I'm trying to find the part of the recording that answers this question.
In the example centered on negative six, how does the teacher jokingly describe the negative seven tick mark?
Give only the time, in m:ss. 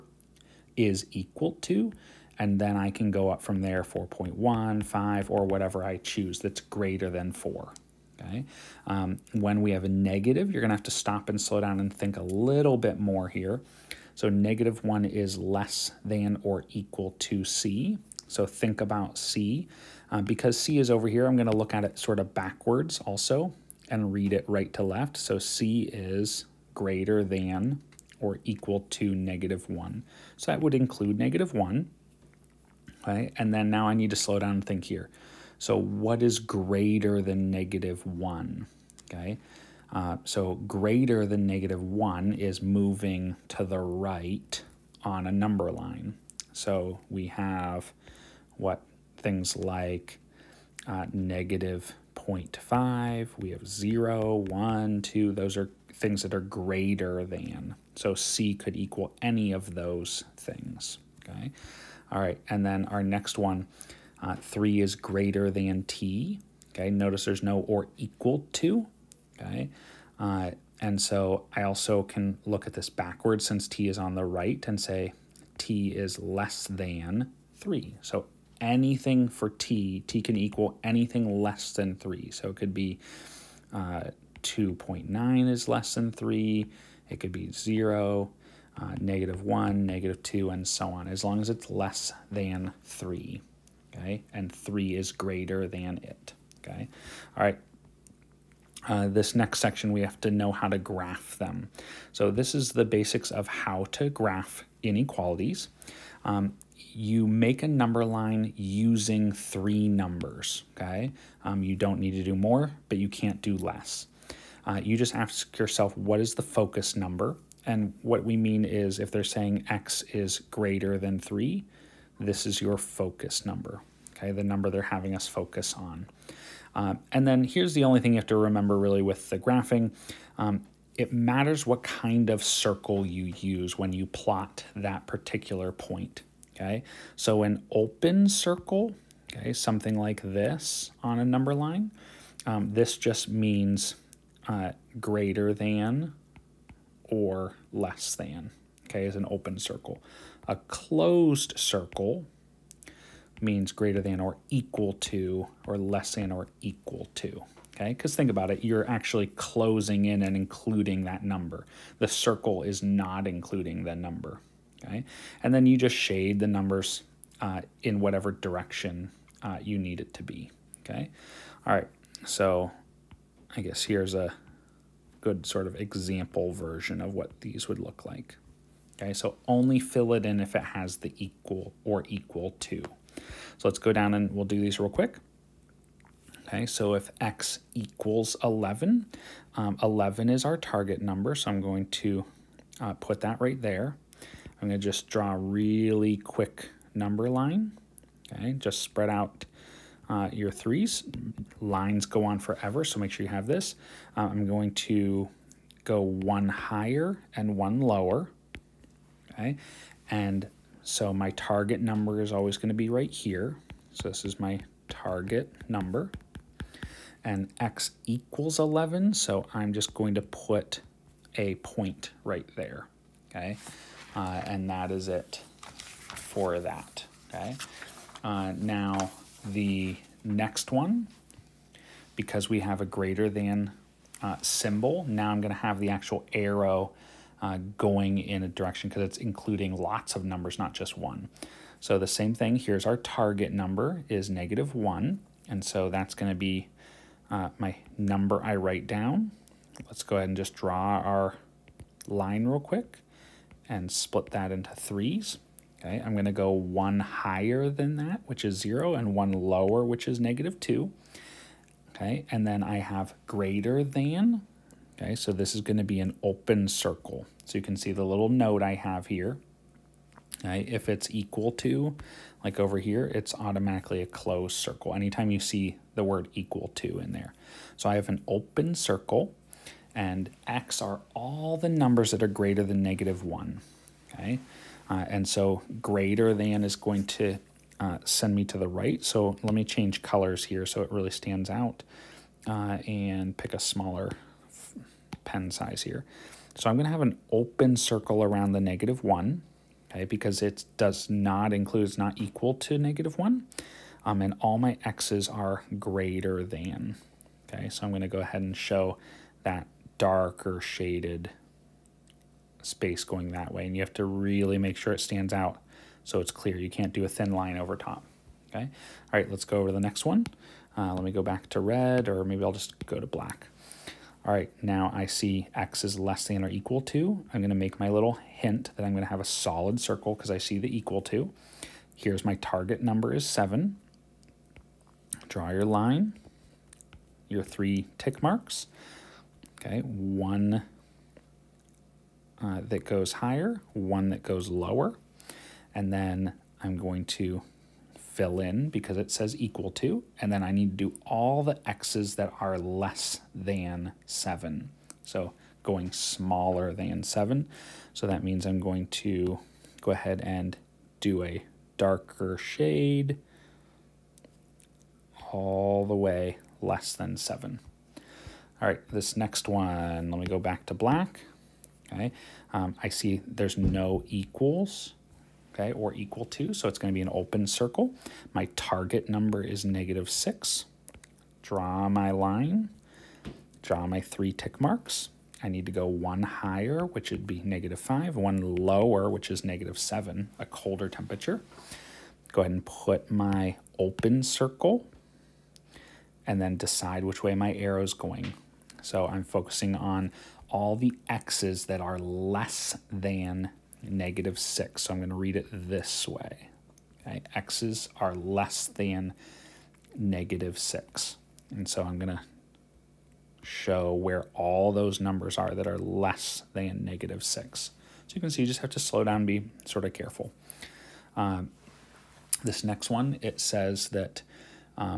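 6:30.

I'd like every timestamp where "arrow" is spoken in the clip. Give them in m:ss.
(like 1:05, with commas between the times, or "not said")
3:56, 6:37.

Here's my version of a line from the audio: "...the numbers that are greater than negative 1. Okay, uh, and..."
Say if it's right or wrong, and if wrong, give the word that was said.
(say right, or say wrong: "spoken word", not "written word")
right.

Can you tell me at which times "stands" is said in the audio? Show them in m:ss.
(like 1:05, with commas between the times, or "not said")
4:51, 5:14.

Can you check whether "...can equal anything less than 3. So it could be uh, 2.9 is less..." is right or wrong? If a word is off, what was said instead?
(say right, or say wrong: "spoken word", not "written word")
right.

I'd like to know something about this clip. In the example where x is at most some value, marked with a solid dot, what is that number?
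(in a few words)
7.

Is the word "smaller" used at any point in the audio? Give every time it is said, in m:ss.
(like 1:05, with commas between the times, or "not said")
4:53, 5:55.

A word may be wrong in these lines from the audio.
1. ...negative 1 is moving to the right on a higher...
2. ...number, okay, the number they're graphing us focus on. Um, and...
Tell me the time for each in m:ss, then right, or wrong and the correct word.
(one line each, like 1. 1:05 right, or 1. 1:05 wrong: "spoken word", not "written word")
1. 0:41 wrong: "number", not "higher"
2. 2:03 wrong: "having", not "graphing".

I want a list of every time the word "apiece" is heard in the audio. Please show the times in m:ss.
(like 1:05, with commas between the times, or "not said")
not said.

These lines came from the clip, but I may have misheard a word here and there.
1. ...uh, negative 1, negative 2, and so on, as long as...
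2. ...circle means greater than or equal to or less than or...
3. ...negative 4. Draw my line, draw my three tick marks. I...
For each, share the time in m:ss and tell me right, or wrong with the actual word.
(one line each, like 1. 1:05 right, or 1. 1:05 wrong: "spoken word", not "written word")
1. 1:28 right
2. 2:31 right
3. 6:19 wrong: "6", not "4".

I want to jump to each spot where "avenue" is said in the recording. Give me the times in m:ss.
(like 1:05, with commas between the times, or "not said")
not said.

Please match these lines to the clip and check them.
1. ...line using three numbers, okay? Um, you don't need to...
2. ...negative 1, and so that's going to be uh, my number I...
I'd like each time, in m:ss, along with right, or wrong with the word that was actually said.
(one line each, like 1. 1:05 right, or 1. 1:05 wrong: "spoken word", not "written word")
1. 1:48 right
2. 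4:04 right.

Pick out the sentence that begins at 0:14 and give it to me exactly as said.
So negative one is less than or equal to C.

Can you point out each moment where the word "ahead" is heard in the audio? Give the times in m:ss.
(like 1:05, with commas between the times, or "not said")
4:10, 5:08, 5:59, 6:32.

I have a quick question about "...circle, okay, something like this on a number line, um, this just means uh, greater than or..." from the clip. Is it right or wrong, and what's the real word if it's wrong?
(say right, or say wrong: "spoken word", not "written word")
right.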